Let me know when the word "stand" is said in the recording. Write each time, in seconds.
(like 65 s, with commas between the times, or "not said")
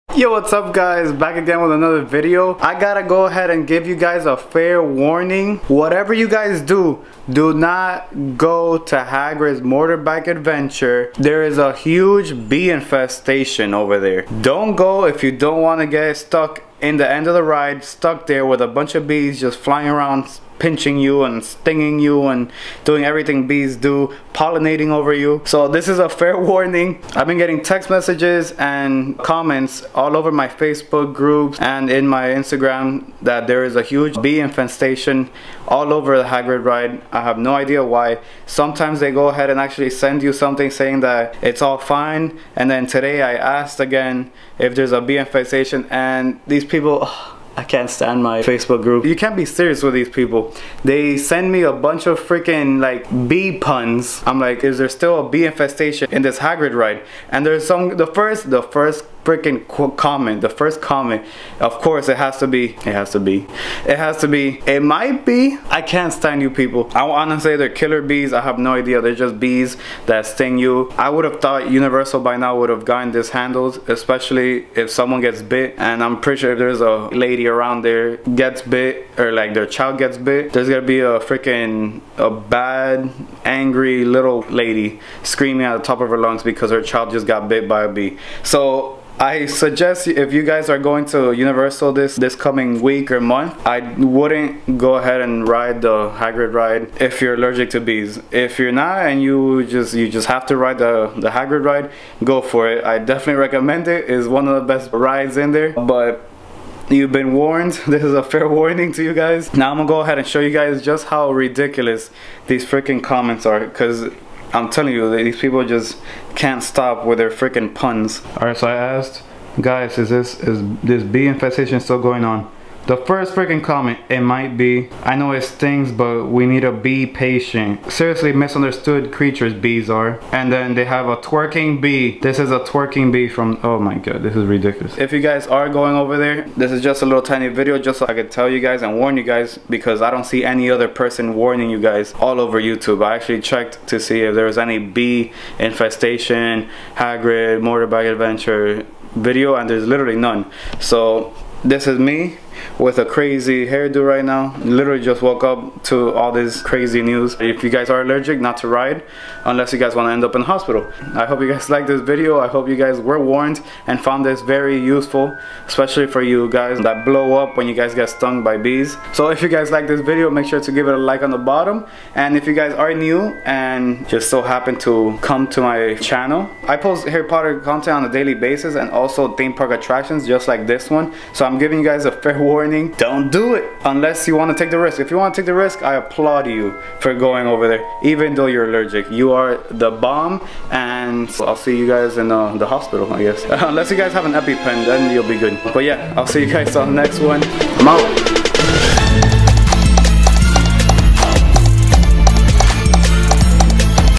47 s, 66 s.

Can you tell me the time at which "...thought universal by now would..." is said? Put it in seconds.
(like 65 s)
71 s.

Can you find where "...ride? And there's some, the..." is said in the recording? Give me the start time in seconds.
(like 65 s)
56 s.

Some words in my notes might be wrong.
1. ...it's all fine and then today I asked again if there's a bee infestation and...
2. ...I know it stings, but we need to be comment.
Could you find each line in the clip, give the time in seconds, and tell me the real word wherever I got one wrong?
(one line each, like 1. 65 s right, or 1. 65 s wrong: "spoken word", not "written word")
1. 41 s right
2. 125 s wrong: "patient", not "comment".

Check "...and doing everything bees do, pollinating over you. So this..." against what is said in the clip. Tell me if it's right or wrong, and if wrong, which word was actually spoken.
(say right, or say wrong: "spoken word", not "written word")
right.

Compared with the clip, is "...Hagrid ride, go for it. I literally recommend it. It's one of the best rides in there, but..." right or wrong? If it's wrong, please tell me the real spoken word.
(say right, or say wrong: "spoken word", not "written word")
wrong: "definitely", not "literally".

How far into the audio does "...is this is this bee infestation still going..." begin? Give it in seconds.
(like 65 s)
119 s.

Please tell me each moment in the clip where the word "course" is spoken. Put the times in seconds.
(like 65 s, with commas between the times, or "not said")
61 s.